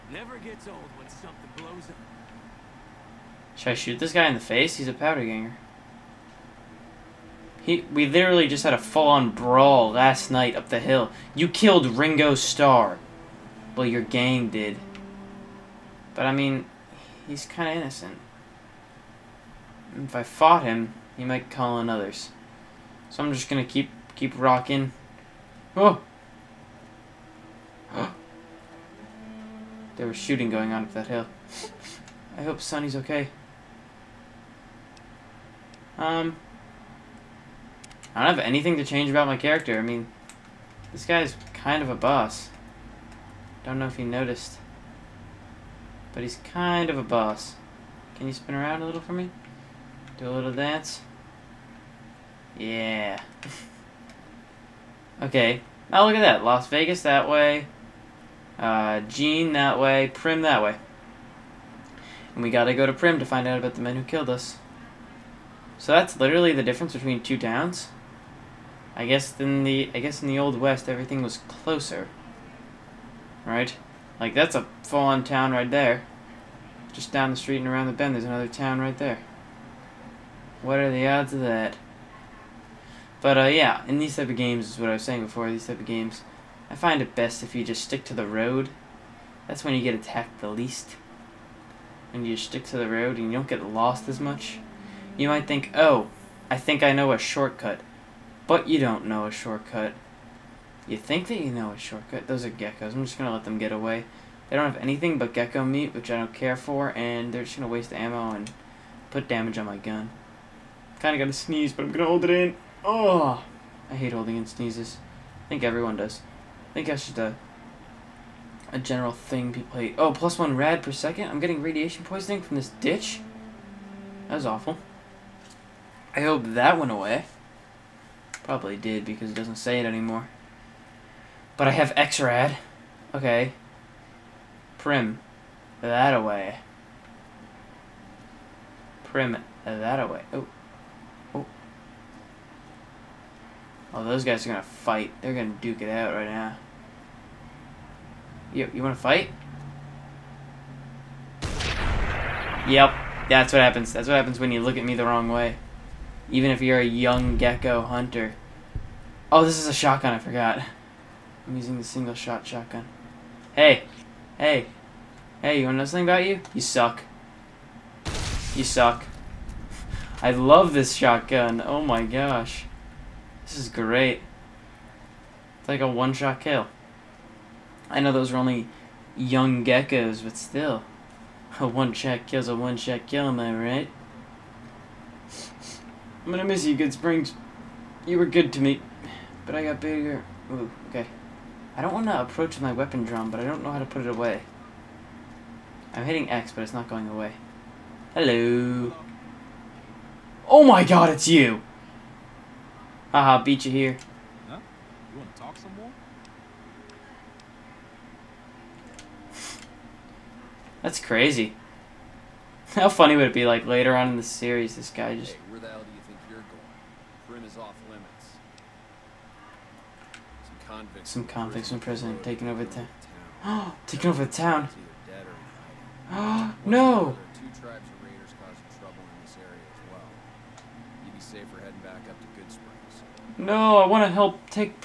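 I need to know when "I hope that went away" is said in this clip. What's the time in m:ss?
2:06.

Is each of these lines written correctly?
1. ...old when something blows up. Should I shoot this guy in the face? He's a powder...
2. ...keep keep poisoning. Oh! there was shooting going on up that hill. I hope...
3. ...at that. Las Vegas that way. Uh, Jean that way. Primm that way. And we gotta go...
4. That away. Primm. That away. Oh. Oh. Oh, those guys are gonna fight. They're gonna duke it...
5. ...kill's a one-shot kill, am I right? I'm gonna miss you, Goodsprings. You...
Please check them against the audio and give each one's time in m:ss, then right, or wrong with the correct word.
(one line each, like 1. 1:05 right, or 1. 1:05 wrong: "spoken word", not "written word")
1. 0:00 right
2. 0:23 wrong: "rocking", not "poisoning"
3. 0:56 right
4. 2:15 right
5. 3:02 right.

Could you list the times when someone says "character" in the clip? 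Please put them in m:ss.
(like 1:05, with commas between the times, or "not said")
0:39.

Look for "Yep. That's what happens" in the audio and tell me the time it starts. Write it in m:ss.
2:32.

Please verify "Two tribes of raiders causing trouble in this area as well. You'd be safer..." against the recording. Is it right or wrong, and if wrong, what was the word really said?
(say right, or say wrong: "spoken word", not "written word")
right.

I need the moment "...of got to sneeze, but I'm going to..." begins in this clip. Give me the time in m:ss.
1:51.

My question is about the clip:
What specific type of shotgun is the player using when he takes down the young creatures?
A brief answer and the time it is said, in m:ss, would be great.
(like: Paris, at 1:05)
Single shot shotgun, at 2:41.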